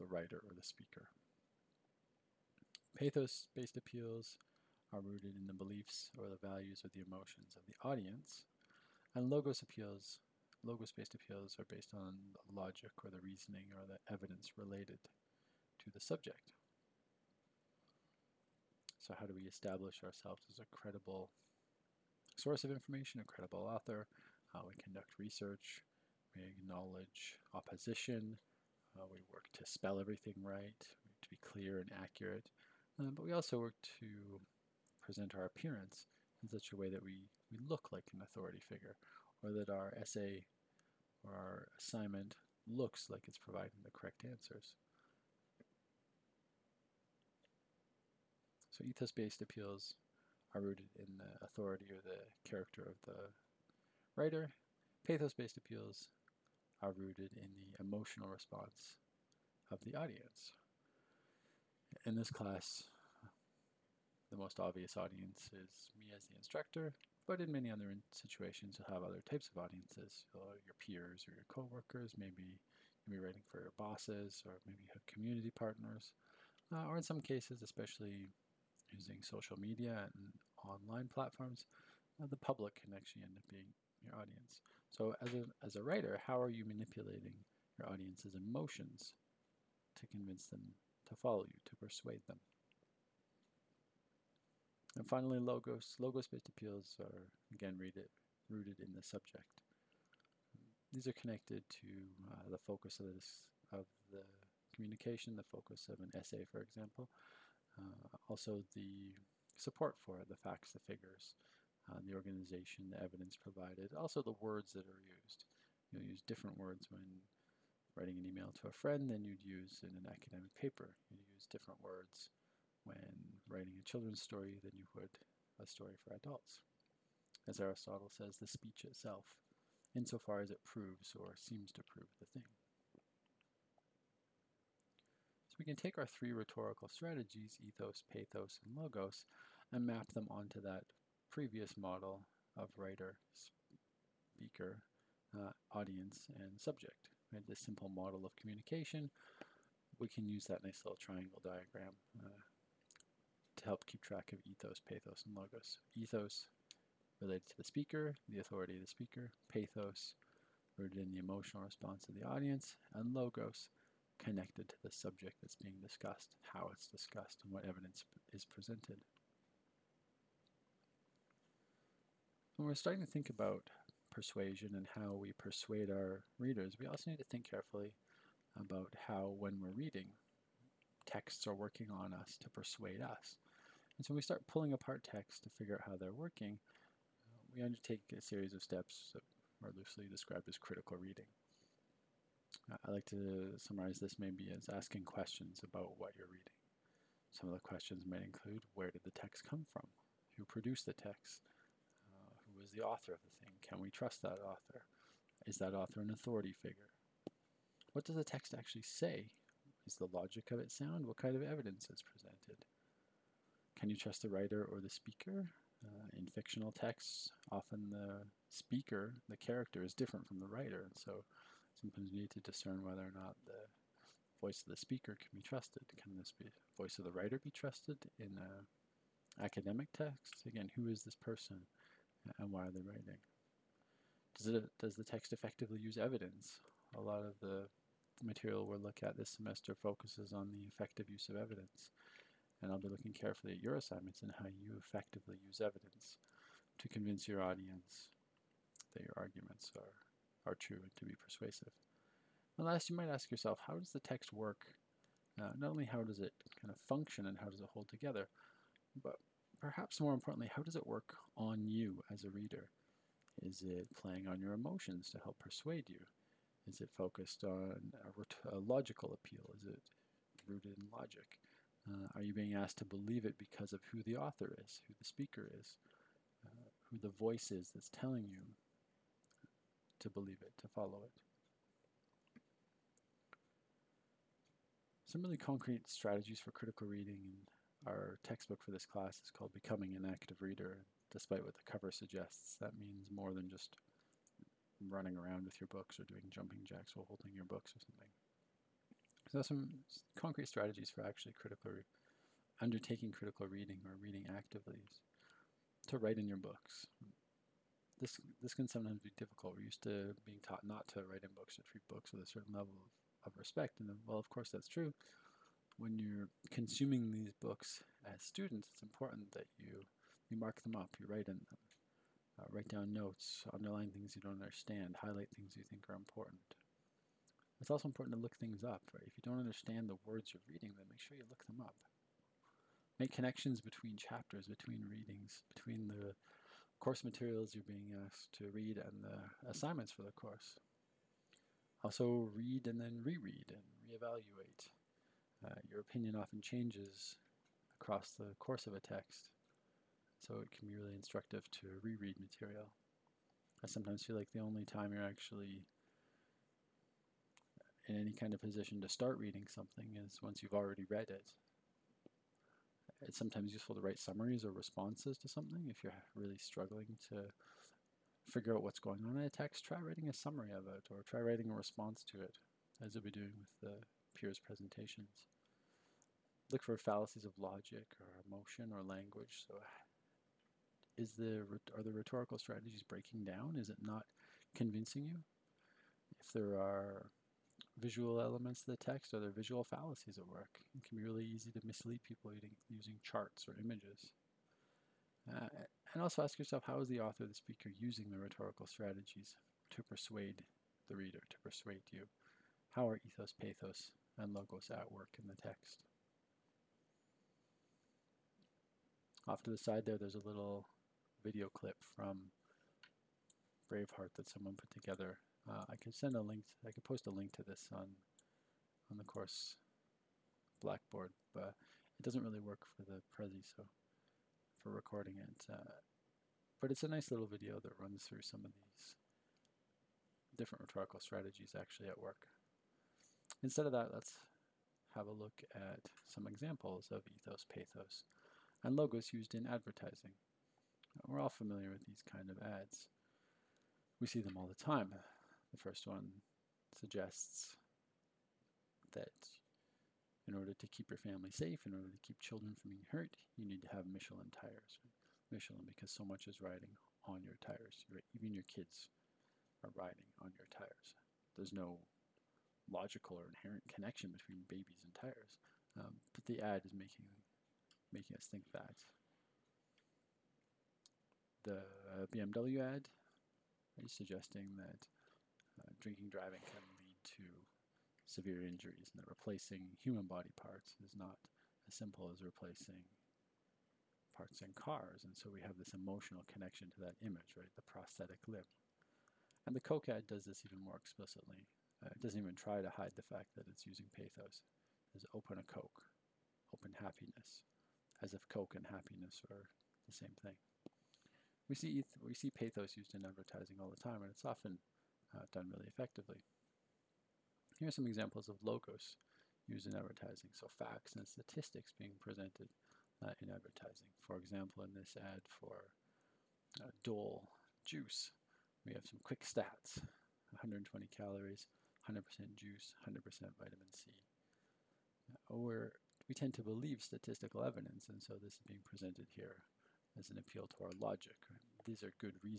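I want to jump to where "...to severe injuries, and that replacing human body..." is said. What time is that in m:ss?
7:57.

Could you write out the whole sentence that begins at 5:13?
And then, well, of course, that's true.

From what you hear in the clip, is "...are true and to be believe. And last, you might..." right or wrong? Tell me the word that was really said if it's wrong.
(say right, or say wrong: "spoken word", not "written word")
wrong: "persuasive", not "believe".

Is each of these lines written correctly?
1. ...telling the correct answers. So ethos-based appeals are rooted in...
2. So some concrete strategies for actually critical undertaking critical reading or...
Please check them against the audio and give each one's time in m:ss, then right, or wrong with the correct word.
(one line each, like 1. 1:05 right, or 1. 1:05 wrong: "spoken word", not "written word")
1. 0:43 wrong: "providing", not "telling"
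2. 4:59 right.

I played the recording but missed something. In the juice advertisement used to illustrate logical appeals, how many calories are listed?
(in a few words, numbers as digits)
120.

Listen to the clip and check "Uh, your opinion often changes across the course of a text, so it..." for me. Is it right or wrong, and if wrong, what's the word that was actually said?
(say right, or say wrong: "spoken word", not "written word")
right.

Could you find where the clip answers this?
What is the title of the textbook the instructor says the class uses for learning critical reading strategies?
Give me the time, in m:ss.
4:49.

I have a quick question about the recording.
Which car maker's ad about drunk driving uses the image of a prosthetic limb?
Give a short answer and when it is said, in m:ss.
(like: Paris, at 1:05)
BMW, at 7:52.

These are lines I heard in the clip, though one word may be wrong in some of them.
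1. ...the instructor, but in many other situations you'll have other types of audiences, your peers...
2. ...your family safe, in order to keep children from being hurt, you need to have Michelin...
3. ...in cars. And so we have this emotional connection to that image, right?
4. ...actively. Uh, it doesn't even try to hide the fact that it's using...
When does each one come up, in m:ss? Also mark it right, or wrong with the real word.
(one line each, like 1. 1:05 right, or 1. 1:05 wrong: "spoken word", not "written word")
1. 1:06 right
2. 7:30 right
3. 8:04 right
4. 8:10 wrong: "explicitly", not "actively".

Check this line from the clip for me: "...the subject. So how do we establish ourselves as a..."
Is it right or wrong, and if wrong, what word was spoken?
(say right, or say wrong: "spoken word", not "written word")
right.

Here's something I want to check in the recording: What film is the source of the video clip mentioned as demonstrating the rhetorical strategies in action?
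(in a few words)
Braveheart.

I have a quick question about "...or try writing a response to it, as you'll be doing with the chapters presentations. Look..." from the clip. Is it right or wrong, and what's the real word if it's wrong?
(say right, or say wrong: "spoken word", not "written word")
wrong: "peers", not "chapters".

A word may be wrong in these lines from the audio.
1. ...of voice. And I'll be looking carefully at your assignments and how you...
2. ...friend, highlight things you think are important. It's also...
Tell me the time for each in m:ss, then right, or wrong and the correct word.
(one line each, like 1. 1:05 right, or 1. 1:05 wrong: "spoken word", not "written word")
1. 4:01 wrong: "evidence", not "voice"
2. 5:24 wrong: "understand", not "friend".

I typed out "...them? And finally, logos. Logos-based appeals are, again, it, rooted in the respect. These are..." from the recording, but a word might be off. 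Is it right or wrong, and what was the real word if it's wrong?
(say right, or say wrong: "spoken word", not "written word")
wrong: "subject", not "respect".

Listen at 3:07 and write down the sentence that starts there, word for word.
we undertake a series of steps that are loosely described as critical reading.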